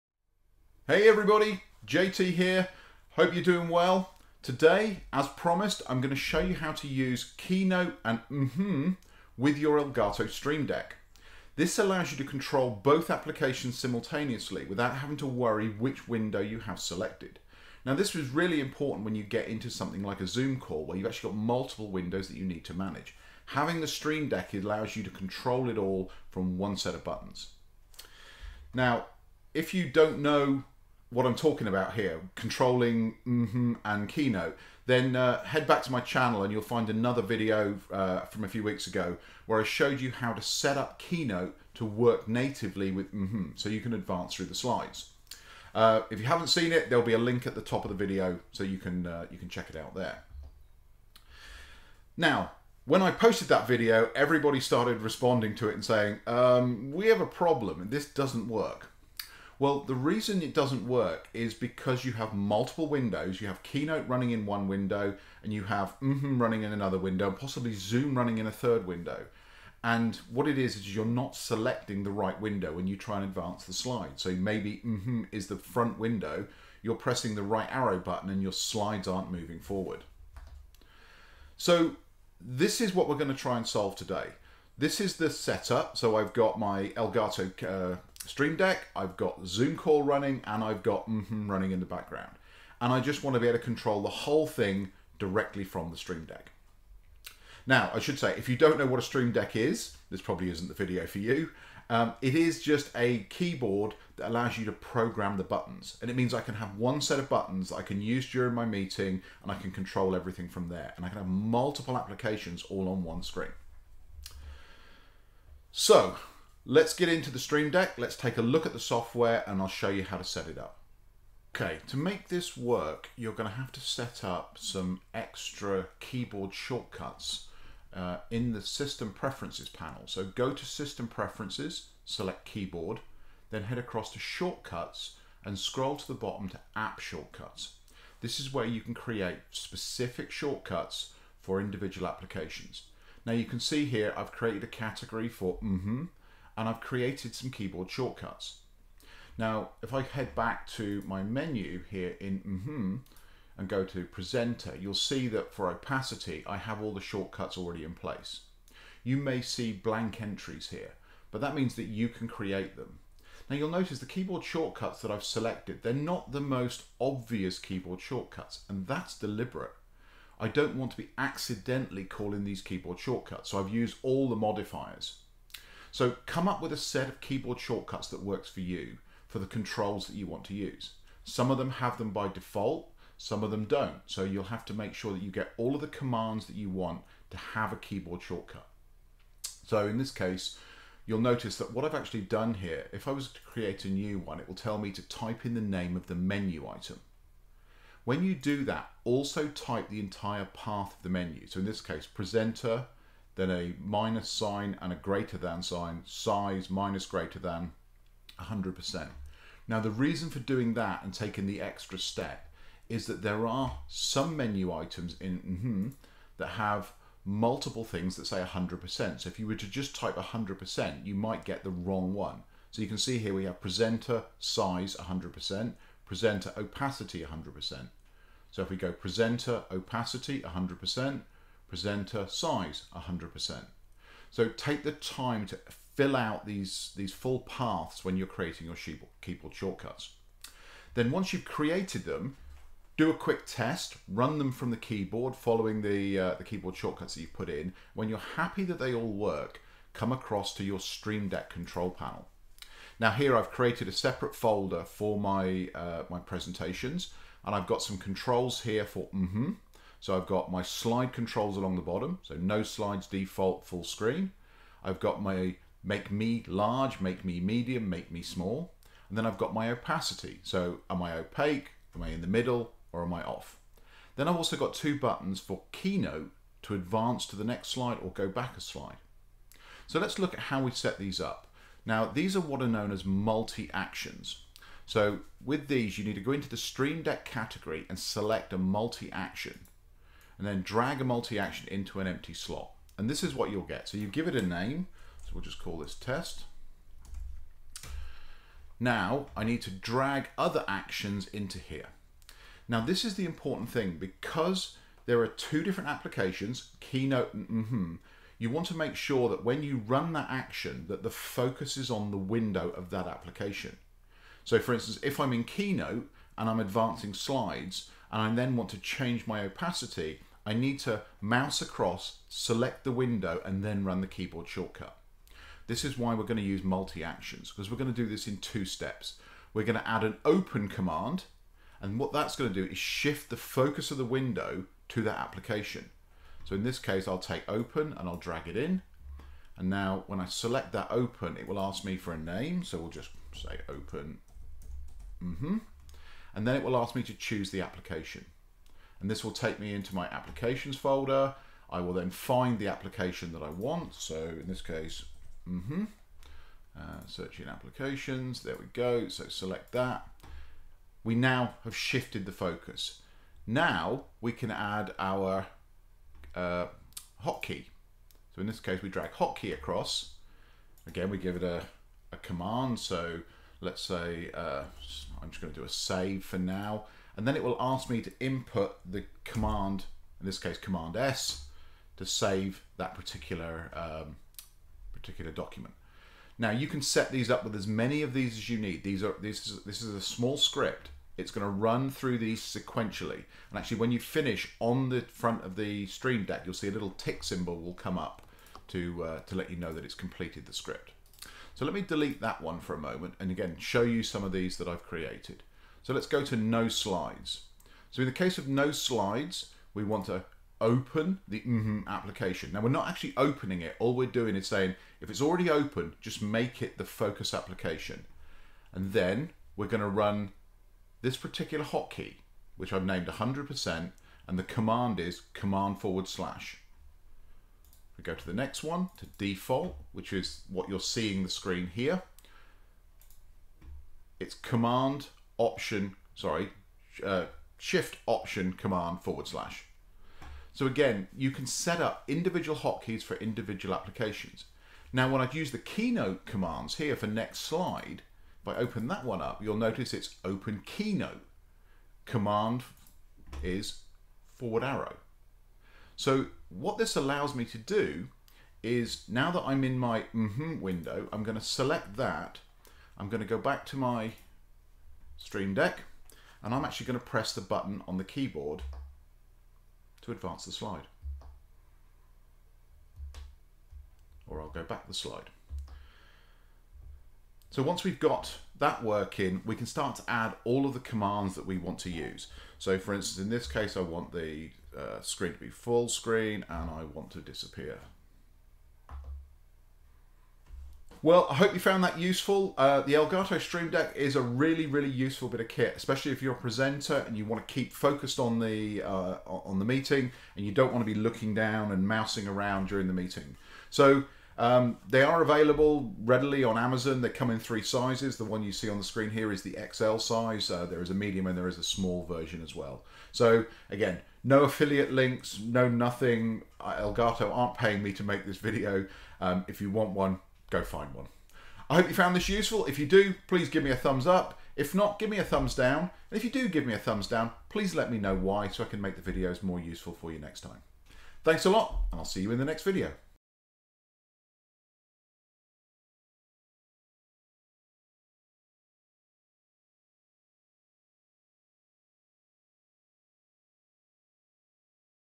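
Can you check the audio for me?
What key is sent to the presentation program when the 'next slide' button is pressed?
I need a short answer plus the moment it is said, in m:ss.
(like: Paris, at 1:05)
forward arrow, at 7:34.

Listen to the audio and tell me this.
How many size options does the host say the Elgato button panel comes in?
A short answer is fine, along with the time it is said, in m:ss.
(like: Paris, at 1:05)
3, at 8:27.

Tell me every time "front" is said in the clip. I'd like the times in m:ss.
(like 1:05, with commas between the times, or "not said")
1:15, 6:35.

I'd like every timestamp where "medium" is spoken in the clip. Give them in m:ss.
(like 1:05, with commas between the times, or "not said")
4:27, 8:30.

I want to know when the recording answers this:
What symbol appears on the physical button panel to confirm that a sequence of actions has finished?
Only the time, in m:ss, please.
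6:36.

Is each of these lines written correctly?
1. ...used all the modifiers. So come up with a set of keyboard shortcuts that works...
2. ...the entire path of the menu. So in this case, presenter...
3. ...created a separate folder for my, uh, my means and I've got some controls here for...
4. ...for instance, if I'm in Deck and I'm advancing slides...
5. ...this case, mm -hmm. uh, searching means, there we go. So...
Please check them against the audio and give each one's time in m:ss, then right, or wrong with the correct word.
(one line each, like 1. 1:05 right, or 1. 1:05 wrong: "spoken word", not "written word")
1. 2:53 right
2. 3:19 right
3. 4:13 wrong: "presentations", not "means"
4. 5:14 wrong: "Keynote", not "Deck"
5. 5:54 wrong: "applications", not "means".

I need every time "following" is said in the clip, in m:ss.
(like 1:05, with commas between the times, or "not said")
4:05.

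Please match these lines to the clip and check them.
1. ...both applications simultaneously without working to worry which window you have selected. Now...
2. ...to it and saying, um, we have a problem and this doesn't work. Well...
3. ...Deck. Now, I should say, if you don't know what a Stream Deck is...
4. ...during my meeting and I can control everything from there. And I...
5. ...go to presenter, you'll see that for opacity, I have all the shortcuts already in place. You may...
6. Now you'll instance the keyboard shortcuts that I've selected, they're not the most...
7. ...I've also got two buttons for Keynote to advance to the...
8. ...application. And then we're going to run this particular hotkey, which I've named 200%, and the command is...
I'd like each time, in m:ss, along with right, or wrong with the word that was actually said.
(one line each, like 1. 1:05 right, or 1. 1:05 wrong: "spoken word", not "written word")
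1. 0:12 wrong: "having", not "working"
2. 0:55 right
3. 1:36 right
4. 1:48 right
5. 2:33 right
6. 2:43 wrong: "notice", not "instance"
7. 4:34 right
8. 6:57 wrong: "100", not "200".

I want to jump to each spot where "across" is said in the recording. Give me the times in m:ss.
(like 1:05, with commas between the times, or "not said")
2:13, 4:10, 5:21, 6:09.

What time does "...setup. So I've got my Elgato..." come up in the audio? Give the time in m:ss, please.
1:25.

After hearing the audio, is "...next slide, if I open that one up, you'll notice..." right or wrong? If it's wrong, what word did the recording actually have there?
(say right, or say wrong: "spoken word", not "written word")
right.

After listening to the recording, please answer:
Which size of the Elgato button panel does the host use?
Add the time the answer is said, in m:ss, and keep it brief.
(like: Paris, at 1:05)
XL, at 8:29.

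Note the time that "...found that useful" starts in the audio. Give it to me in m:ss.
8:11.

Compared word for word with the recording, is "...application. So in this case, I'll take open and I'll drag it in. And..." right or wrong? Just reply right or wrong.
right.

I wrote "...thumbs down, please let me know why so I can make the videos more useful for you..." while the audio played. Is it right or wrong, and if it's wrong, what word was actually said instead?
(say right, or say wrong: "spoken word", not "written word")
right.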